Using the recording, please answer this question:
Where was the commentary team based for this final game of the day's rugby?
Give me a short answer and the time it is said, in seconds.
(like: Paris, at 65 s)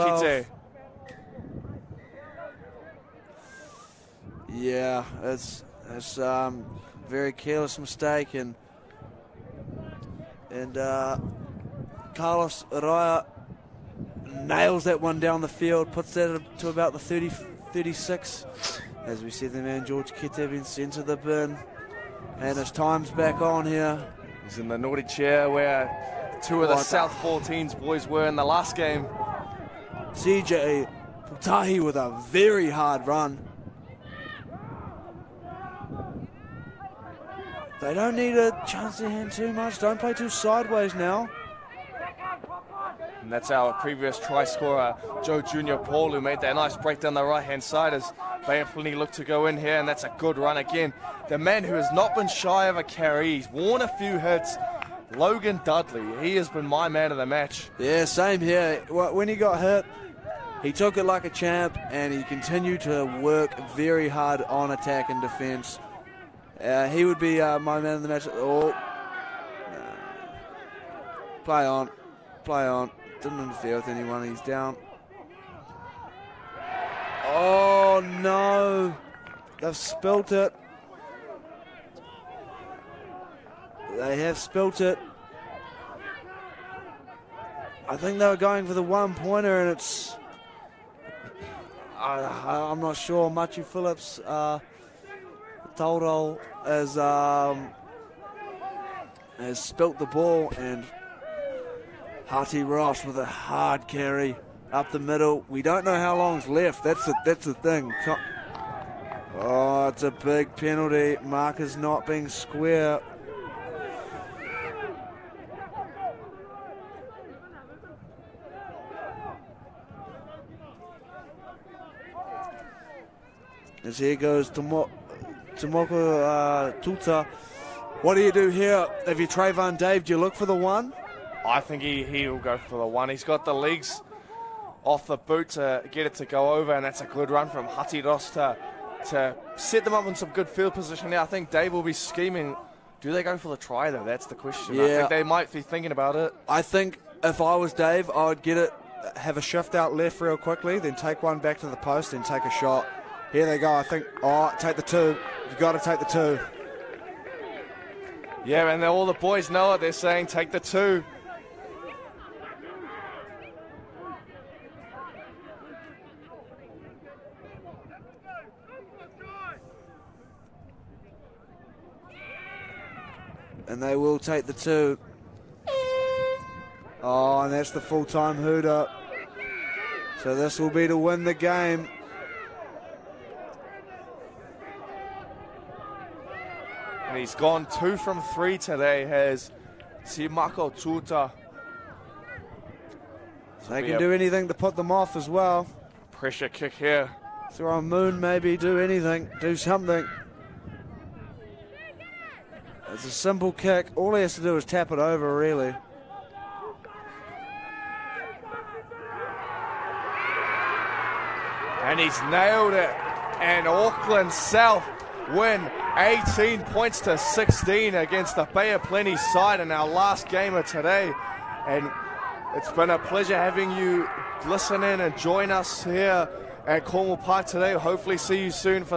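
Cornwall Park, at 226 s.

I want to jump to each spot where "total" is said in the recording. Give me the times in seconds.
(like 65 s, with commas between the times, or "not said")
not said.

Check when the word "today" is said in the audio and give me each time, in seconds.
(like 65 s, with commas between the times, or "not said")
188 s, 220 s, 227 s.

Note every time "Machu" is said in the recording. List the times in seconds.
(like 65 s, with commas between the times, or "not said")
93 s.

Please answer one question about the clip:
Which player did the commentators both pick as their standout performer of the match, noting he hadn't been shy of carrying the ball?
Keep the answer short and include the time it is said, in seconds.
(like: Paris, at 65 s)
Logan Dudley, at 55 s.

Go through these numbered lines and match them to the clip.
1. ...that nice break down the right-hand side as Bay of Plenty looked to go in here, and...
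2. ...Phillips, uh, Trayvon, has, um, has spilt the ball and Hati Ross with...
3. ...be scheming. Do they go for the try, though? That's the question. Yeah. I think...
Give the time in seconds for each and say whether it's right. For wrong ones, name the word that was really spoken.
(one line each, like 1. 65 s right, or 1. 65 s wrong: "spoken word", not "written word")
1. 46 s right
2. 93 s wrong: "Toldo", not "Trayvon"
3. 141 s right.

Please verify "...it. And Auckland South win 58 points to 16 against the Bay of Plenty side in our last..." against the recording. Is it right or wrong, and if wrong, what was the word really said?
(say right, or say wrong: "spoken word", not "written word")
wrong: "18", not "58".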